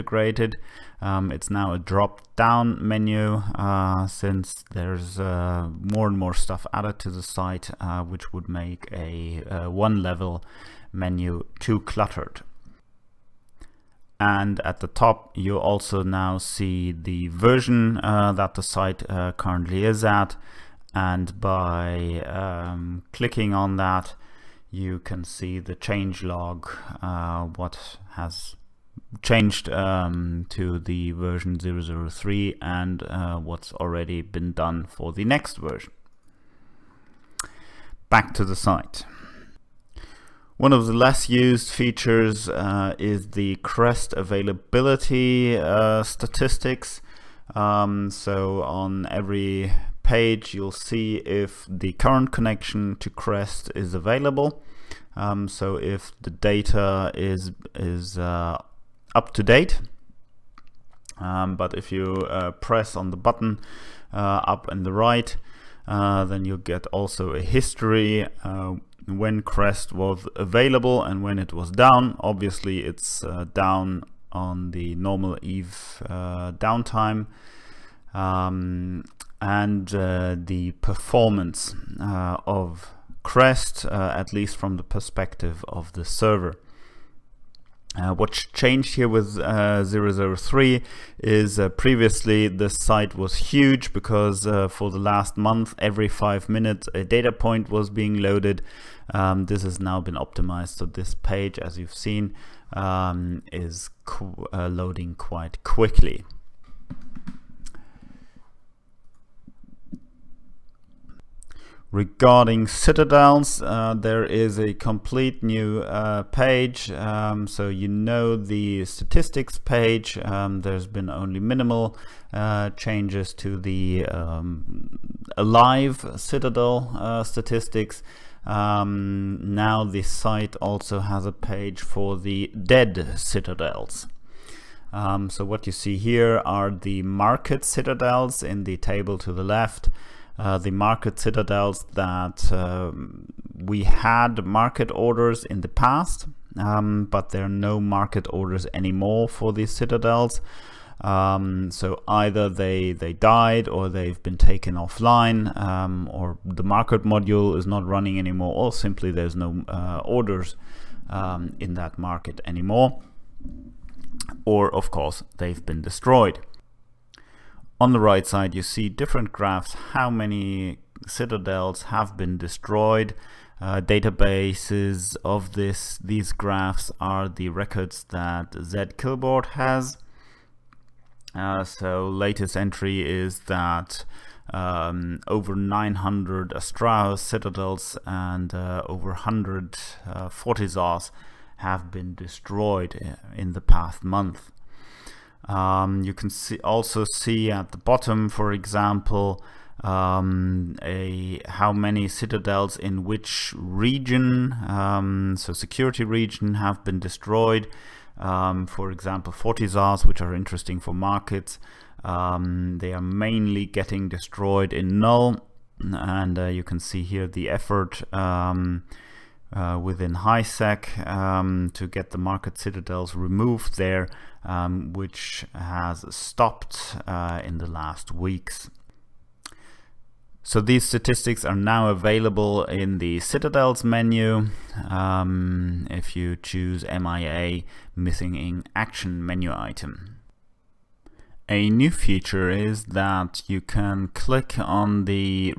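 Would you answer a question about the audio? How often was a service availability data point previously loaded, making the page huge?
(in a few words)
every 5 minutes.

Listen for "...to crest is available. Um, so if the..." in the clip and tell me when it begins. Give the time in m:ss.
0:52.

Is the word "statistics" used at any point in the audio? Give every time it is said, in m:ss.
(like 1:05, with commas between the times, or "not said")
0:46, 1:58, 2:07, 3:50.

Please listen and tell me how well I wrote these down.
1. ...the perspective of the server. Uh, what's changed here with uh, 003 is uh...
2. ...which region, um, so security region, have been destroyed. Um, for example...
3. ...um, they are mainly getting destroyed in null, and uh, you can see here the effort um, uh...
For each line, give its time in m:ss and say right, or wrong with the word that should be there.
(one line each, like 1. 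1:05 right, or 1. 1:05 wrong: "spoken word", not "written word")
1. 1:24 right
2. 3:23 right
3. 3:32 right.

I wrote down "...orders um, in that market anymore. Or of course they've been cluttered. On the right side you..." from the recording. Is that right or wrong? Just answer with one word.
wrong.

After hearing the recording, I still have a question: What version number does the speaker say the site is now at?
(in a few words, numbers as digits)
003.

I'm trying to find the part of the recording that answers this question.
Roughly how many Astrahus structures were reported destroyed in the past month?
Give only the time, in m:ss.
3:05.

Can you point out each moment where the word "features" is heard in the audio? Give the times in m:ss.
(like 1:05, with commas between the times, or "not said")
0:41, 4:01.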